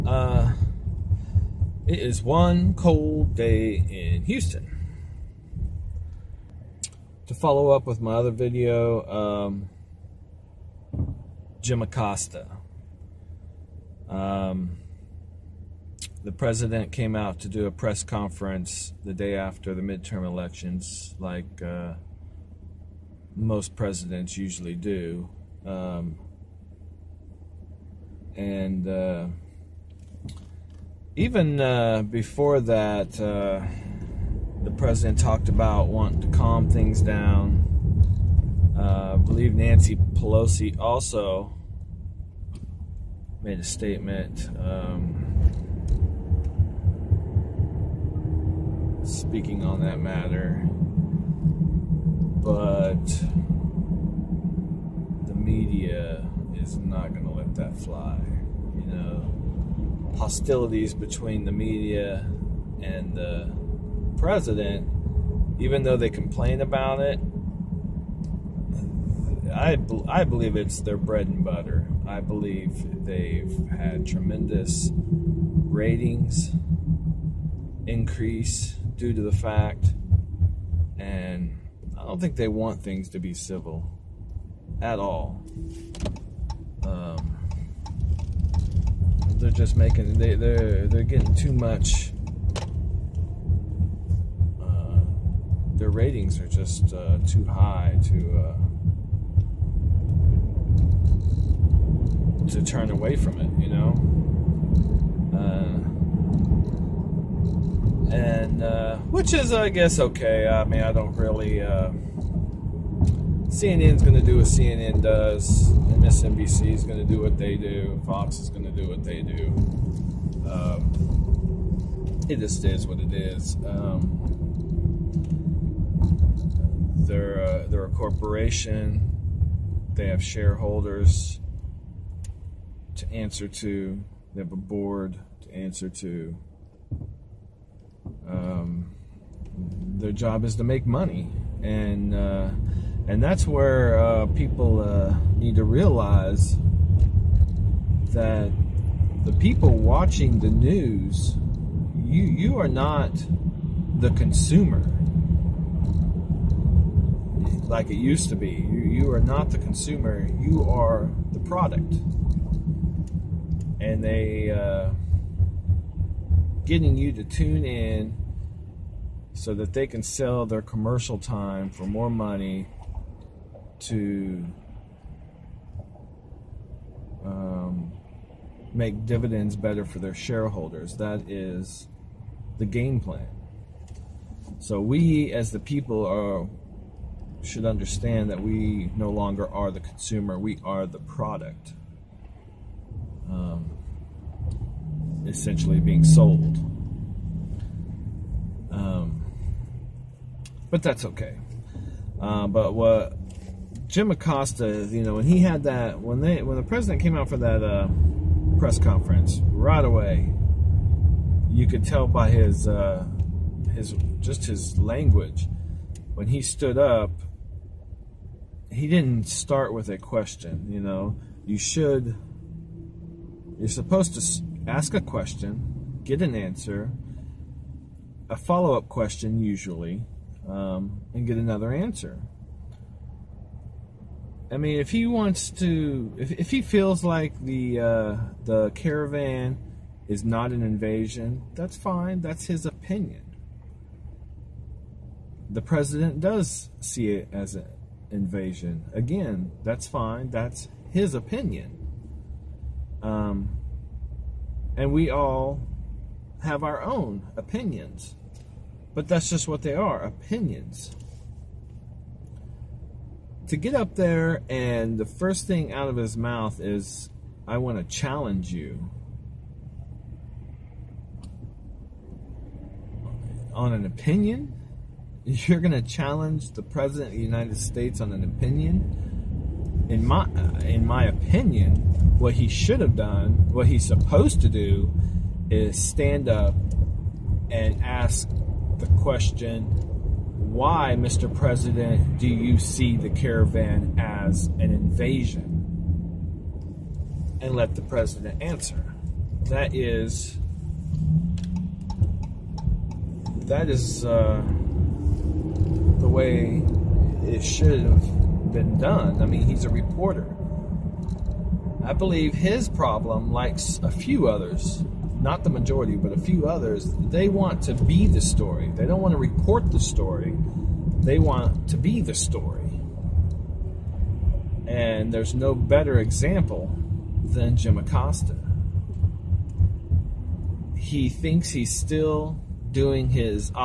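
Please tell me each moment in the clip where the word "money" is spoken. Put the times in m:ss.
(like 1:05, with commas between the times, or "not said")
2:20, 2:52.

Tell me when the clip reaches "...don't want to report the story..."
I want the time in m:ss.
5:18.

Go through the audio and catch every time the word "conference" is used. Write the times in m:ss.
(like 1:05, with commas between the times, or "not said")
0:18, 3:28.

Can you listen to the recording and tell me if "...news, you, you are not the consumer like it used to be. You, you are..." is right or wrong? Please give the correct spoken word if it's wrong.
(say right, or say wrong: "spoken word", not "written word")
right.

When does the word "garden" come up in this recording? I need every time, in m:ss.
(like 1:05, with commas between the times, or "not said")
not said.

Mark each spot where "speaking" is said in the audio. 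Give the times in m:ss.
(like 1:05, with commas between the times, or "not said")
0:49.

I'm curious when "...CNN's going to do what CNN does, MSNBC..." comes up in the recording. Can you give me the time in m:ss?
1:53.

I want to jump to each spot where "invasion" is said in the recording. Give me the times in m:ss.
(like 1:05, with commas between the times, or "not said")
4:00, 4:08, 4:54.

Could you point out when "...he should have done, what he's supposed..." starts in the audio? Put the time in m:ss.
4:42.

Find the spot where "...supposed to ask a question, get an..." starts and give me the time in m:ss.
3:43.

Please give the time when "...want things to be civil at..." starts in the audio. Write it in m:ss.
1:22.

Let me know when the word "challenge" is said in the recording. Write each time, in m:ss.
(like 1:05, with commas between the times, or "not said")
4:27, 4:35.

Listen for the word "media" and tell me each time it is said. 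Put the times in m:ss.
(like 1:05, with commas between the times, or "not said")
0:55, 1:01.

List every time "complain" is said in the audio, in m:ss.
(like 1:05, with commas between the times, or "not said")
1:06.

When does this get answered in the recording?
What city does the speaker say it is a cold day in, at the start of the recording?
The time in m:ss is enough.
0:04.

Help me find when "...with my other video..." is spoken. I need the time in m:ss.
0:07.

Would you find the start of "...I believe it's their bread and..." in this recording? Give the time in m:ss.
1:10.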